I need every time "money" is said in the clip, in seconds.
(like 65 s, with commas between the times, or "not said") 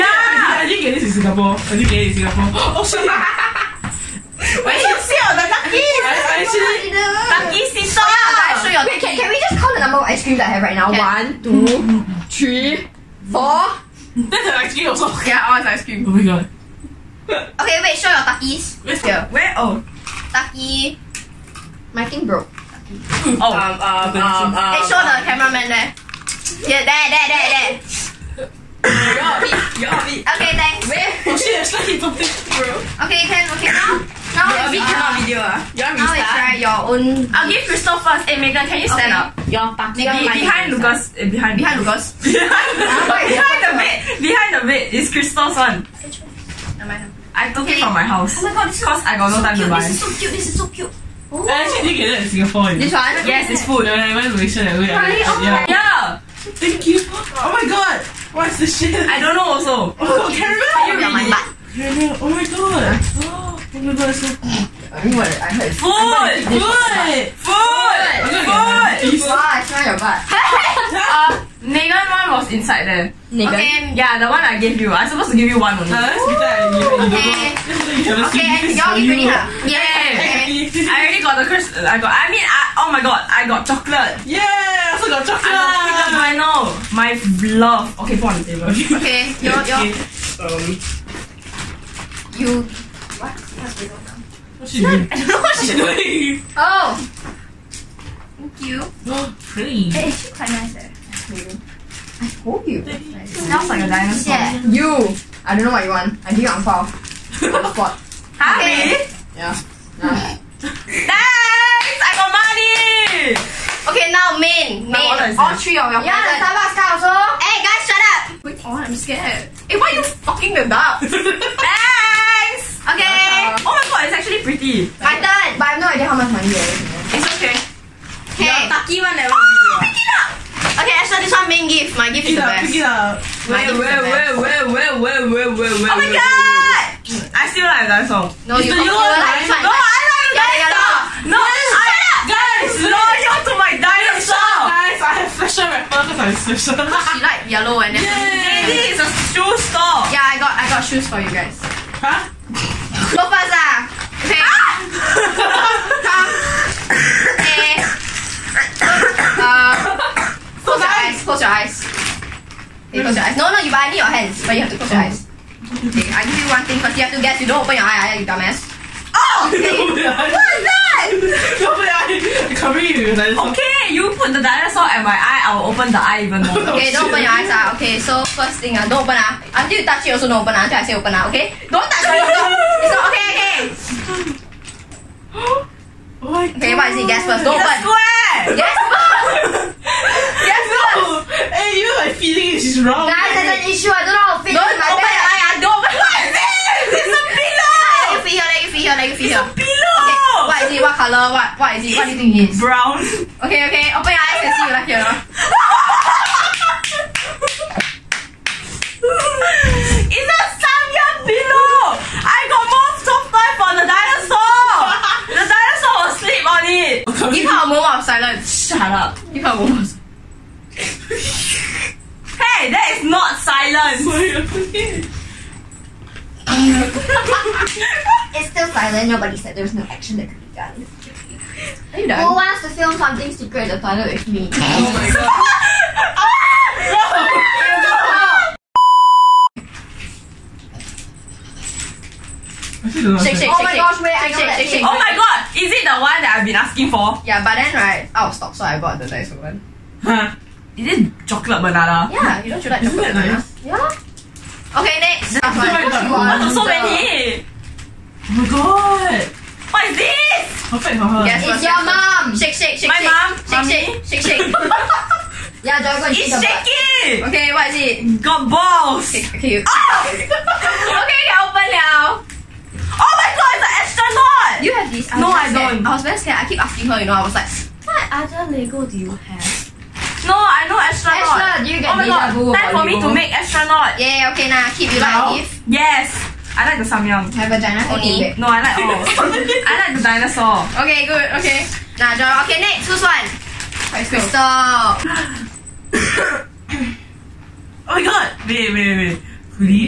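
112 s, 126 s.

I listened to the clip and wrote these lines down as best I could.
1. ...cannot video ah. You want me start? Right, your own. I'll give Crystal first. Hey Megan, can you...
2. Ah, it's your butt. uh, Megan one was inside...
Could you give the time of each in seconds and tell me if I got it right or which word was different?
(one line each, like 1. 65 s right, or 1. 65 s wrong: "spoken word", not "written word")
1. 34 s right
2. 68 s right.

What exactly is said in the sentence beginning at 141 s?
No, I guys, no, you to my dinosaur.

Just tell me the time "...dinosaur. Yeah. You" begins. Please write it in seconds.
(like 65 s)
103 s.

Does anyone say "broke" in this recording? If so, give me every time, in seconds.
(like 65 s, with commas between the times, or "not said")
22 s.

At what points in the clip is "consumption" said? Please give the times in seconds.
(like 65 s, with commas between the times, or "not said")
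not said.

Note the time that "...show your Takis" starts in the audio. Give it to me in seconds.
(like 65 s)
17 s.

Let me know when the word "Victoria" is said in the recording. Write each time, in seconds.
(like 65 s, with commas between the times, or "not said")
not said.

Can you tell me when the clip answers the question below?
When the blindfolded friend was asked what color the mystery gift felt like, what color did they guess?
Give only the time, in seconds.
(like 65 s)
202 s.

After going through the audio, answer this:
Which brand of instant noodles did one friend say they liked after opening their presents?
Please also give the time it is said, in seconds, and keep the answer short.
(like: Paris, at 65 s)
Samyang, at 286 s.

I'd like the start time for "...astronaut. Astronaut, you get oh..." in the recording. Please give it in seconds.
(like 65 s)
280 s.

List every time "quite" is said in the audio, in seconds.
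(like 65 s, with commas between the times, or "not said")
100 s.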